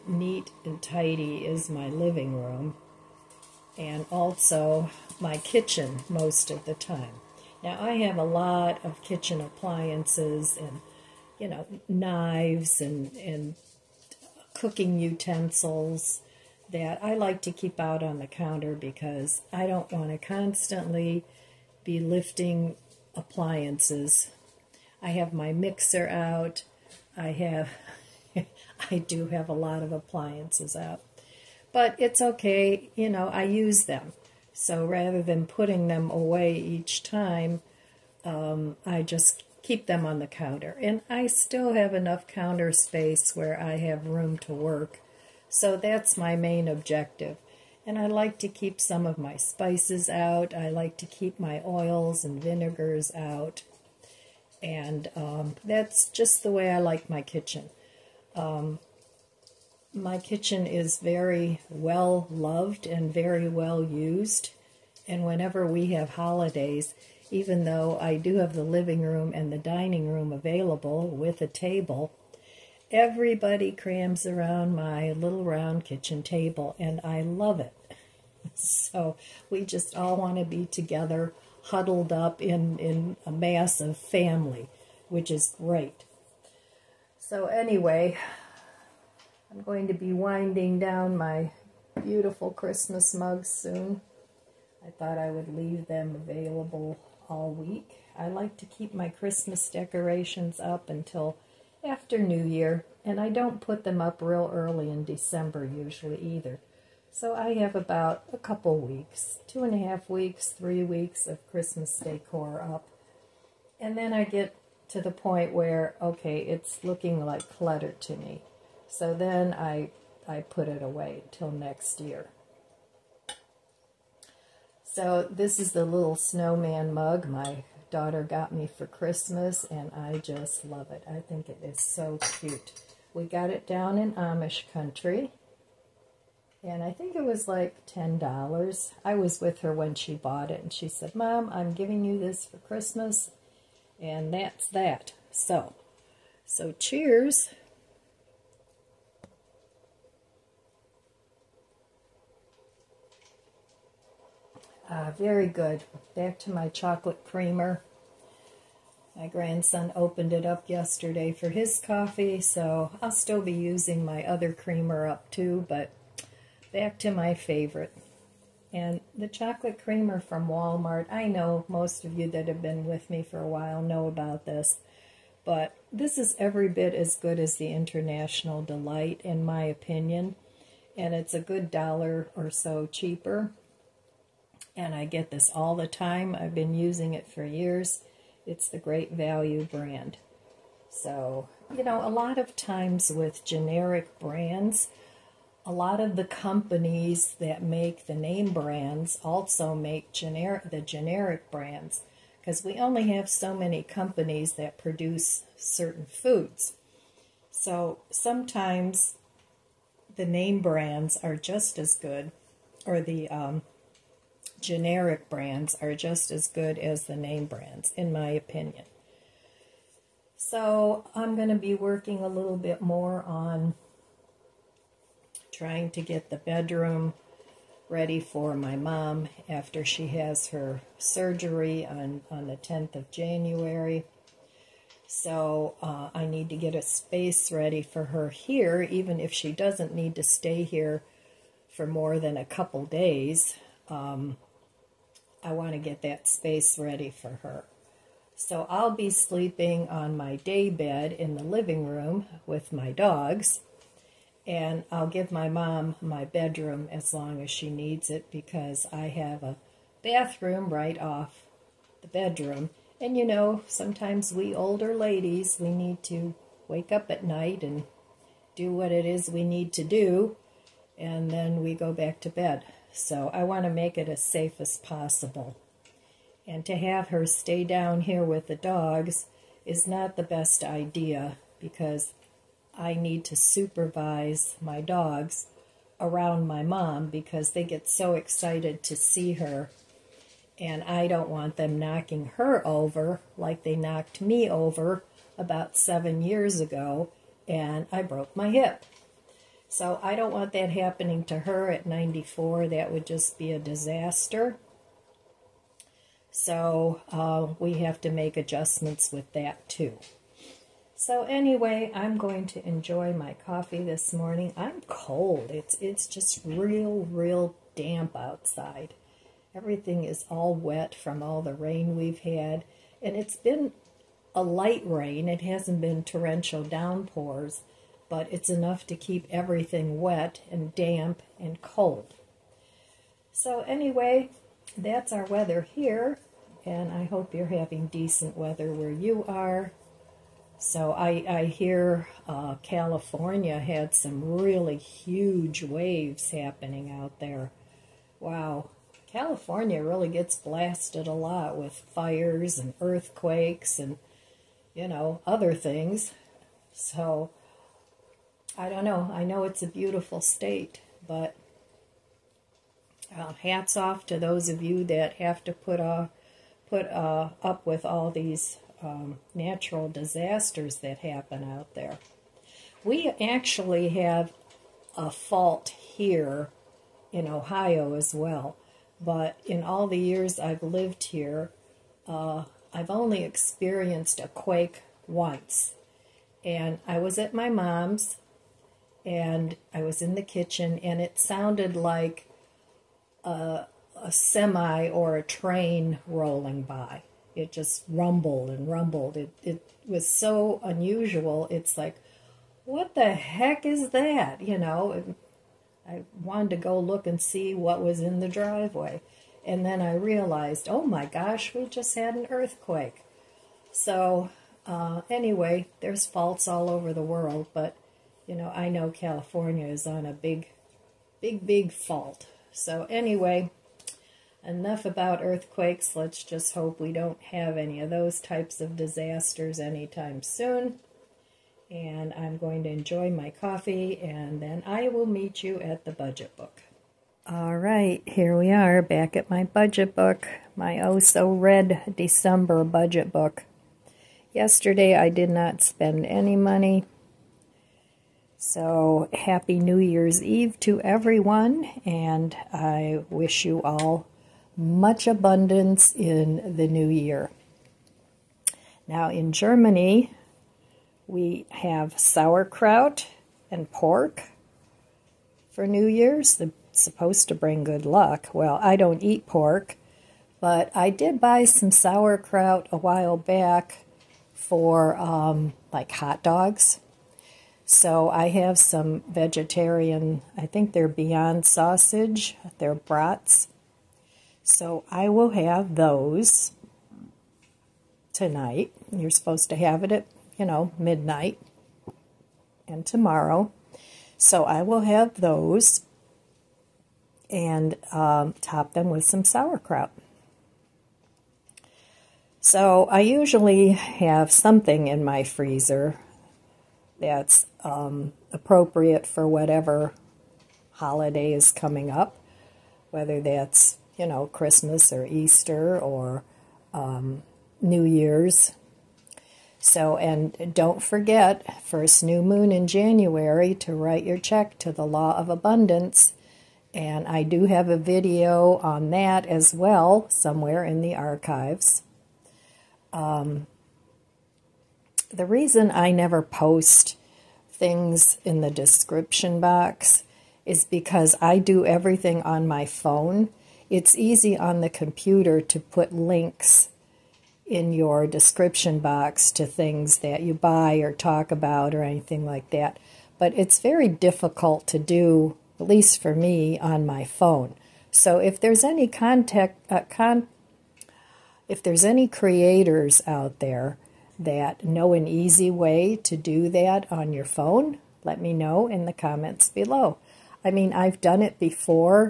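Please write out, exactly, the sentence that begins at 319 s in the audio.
Everything is all wet from all the rain we've had.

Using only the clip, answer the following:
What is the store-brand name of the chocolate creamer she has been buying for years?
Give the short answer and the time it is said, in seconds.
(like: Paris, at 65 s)
Great Value, at 188 s.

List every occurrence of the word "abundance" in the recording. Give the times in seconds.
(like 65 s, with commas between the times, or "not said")
455 s, 525 s.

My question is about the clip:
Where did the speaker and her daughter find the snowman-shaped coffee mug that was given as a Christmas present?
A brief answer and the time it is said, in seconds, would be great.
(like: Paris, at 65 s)
Amish country, at 134 s.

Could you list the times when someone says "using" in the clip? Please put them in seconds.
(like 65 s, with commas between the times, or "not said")
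163 s, 186 s.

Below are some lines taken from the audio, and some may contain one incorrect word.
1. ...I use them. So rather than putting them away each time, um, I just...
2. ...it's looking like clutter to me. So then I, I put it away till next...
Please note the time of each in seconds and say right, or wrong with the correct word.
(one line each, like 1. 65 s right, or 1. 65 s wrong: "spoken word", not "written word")
1. 33 s right
2. 116 s right.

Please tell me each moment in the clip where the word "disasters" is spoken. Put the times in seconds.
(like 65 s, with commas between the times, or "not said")
303 s, 369 s, 428 s.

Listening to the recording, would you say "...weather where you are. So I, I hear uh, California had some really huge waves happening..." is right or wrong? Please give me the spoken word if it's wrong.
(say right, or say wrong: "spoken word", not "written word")
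right.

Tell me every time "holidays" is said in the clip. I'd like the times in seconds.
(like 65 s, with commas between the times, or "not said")
66 s, 510 s.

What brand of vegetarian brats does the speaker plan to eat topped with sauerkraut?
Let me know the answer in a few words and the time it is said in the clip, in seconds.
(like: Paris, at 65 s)
Beyond Sausage, at 480 s.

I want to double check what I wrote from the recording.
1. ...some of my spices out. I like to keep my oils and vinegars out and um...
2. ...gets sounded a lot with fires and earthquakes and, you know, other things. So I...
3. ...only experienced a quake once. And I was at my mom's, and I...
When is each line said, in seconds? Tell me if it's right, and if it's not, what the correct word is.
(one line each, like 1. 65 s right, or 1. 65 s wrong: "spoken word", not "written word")
1. 48 s right
2. 350 s wrong: "blasted", not "sounded"
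3. 382 s right.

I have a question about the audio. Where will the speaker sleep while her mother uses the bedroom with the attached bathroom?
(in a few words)
day bed.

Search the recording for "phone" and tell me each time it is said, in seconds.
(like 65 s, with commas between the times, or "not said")
542 s, 557 s, 567 s.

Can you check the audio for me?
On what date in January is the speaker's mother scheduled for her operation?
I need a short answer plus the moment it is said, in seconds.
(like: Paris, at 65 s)
10th, at 232 s.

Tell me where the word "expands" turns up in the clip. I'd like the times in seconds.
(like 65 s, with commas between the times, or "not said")
not said.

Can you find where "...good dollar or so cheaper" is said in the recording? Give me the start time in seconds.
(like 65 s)
181 s.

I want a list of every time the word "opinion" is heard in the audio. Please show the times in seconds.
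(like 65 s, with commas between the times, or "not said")
179 s, 218 s.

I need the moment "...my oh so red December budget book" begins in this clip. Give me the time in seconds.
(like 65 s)
440 s.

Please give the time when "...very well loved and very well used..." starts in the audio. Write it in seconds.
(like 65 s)
60 s.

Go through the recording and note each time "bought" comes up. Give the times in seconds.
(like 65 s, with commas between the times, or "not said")
140 s.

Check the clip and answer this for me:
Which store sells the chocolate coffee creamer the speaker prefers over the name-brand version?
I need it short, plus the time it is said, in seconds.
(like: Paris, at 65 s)
Walmart, at 170 s.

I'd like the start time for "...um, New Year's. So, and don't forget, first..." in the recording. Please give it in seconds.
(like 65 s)
516 s.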